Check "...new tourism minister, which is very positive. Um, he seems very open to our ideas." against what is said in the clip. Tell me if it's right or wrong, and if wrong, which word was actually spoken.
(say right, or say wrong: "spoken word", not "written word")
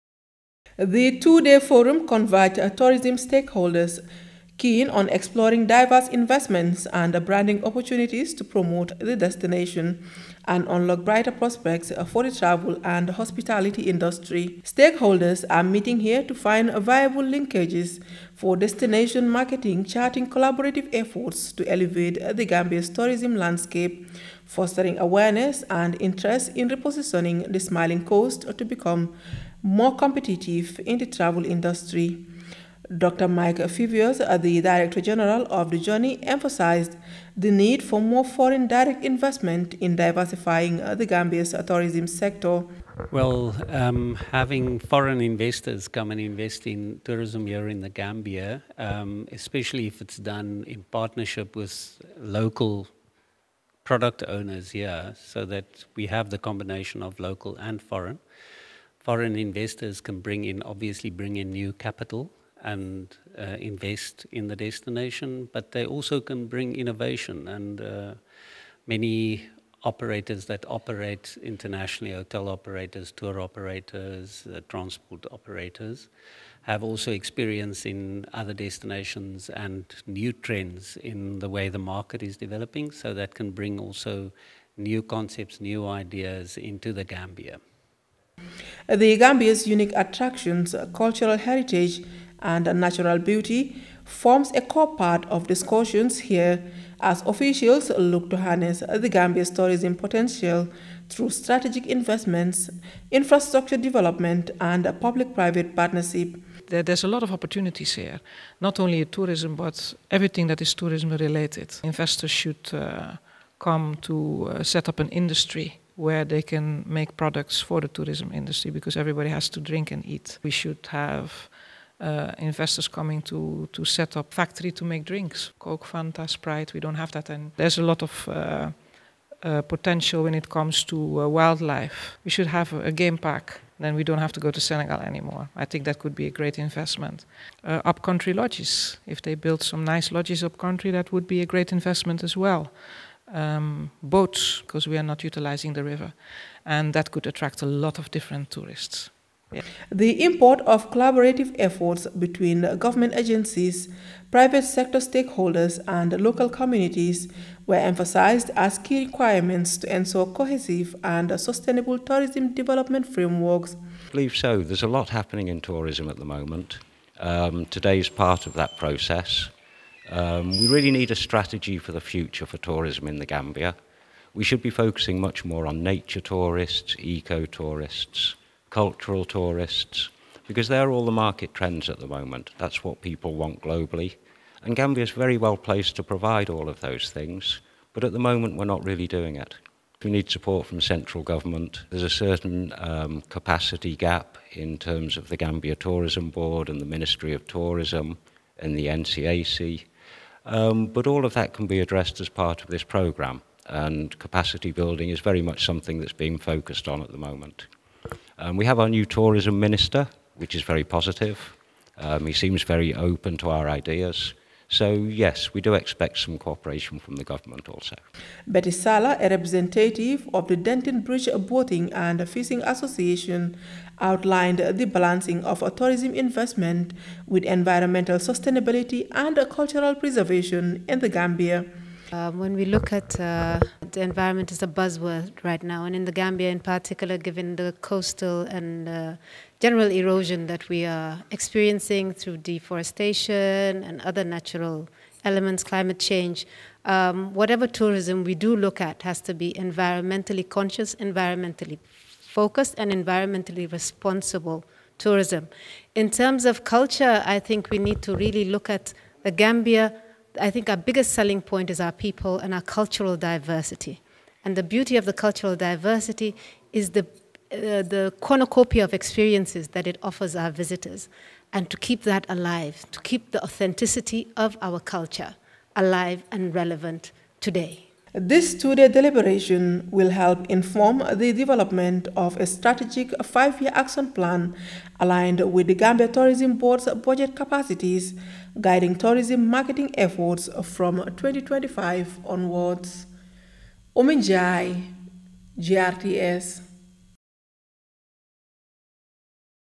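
right.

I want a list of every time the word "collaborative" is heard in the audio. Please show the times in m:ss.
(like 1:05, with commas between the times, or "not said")
0:20, 2:30.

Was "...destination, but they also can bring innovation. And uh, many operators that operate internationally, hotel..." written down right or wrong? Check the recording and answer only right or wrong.
right.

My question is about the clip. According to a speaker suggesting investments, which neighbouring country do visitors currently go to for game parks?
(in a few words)
Senegal.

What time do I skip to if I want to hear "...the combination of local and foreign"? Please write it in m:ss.
0:56.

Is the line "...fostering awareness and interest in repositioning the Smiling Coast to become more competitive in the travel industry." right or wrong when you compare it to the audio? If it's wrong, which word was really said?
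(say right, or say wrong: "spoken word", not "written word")
right.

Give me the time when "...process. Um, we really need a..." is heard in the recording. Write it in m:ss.
2:48.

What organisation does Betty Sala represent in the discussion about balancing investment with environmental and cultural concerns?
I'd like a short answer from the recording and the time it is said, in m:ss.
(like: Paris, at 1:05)
Denton Bridge Boating and Fishing Association, at 3:40.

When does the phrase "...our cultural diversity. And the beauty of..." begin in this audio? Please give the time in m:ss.
4:22.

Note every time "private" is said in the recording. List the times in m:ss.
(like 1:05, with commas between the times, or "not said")
1:45, 2:34.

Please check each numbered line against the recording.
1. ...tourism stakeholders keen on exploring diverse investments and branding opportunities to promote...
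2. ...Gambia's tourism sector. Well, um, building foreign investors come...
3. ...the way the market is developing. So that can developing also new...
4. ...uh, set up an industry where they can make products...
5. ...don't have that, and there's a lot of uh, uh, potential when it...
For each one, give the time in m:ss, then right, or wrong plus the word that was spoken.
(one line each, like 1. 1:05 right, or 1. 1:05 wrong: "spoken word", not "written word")
1. 0:02 right
2. 0:41 wrong: "having", not "building"
3. 1:21 wrong: "bring", not "developing"
4. 1:54 right
5. 2:06 right.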